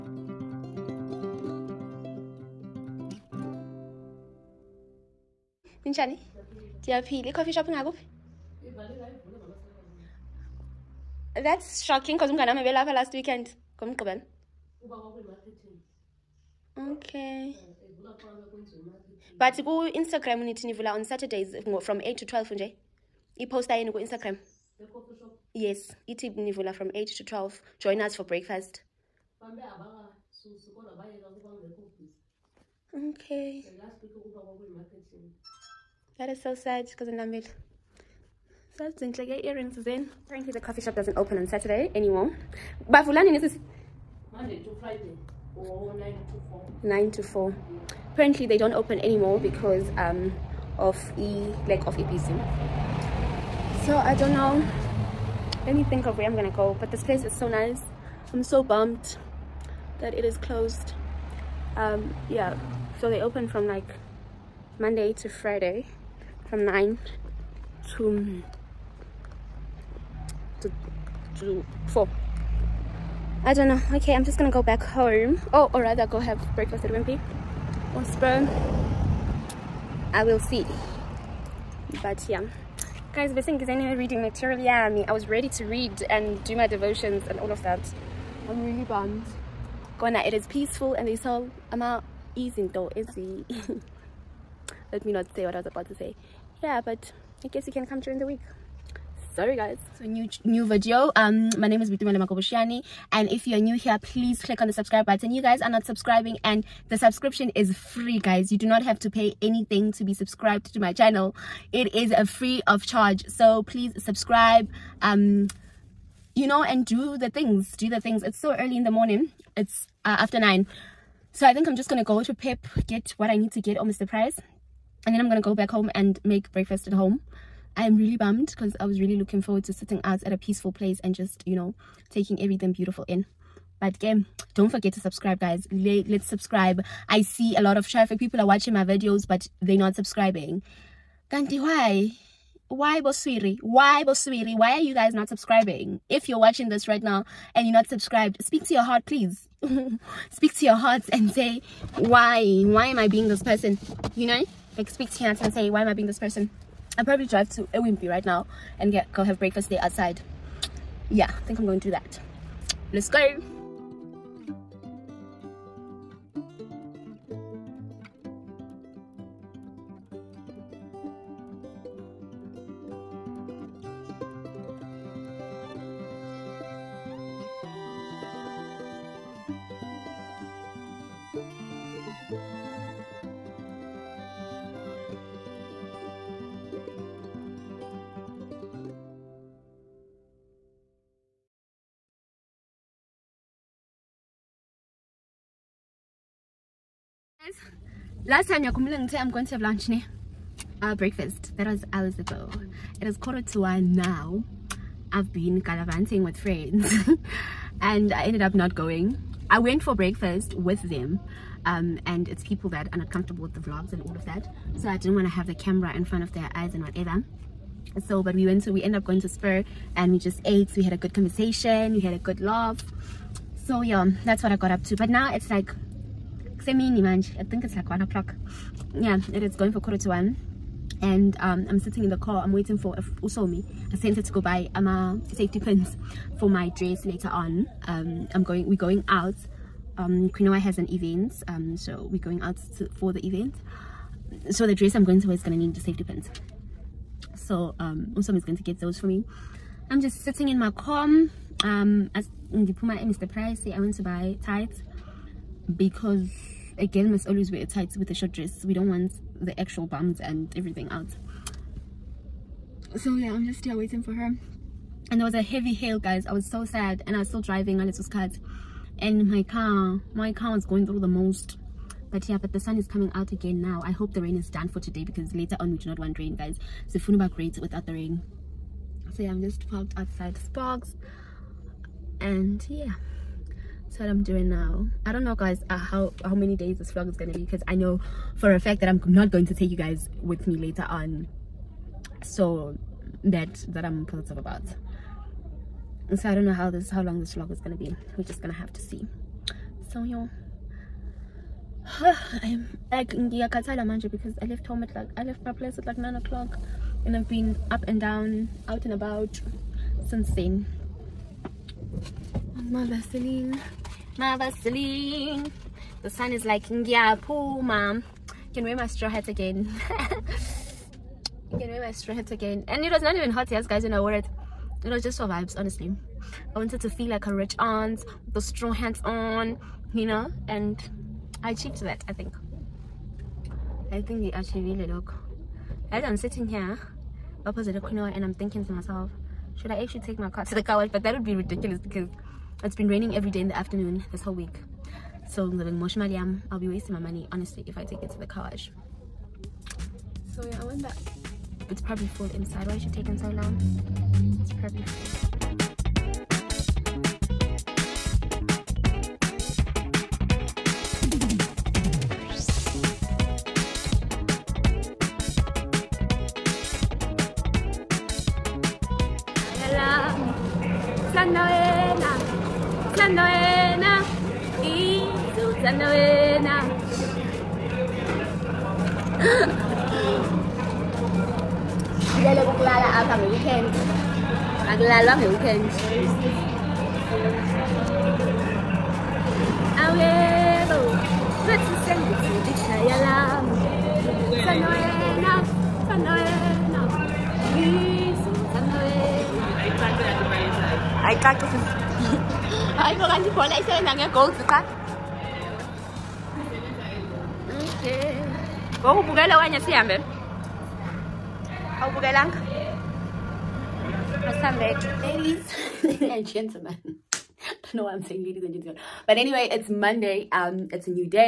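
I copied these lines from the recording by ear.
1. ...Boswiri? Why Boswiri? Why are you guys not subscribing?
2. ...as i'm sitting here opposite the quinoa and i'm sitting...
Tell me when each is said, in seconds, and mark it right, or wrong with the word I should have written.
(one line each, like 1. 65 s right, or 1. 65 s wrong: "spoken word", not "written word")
1. 142 s right
2. 335 s wrong: "thinking", not "sitting".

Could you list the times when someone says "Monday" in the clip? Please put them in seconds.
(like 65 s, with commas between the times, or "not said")
44 s, 64 s, 419 s.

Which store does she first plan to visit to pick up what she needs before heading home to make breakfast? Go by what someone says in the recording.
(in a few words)
Pep.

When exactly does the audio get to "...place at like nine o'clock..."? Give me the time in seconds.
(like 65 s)
305 s.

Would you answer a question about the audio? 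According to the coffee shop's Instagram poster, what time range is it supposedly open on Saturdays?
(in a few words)
8 to 12.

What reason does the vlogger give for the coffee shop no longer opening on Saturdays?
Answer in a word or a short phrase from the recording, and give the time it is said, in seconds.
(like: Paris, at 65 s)
lack of EPC, at 51 s.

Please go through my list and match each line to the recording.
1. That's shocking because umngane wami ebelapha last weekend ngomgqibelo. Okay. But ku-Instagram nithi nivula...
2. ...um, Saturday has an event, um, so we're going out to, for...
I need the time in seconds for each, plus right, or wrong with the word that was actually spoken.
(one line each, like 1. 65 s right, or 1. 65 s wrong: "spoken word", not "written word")
1. 11 s right
2. 239 s wrong: "Quinoa", not "Saturday".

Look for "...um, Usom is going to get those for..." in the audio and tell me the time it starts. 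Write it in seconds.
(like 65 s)
247 s.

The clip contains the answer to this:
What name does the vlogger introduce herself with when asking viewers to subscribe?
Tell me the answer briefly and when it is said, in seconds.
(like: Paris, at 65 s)
Boitumelo Makobosheane, at 101 s.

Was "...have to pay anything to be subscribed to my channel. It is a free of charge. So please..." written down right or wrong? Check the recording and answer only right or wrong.
right.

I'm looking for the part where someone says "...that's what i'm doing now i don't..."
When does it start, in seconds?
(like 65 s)
283 s.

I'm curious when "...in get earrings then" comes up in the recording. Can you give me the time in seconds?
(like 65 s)
39 s.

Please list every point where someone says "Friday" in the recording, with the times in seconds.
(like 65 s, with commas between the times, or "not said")
44 s, 65 s.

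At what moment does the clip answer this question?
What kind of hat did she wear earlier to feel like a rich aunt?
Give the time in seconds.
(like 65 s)
318 s.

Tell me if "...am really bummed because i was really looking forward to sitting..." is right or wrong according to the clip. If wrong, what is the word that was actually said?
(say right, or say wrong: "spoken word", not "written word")
right.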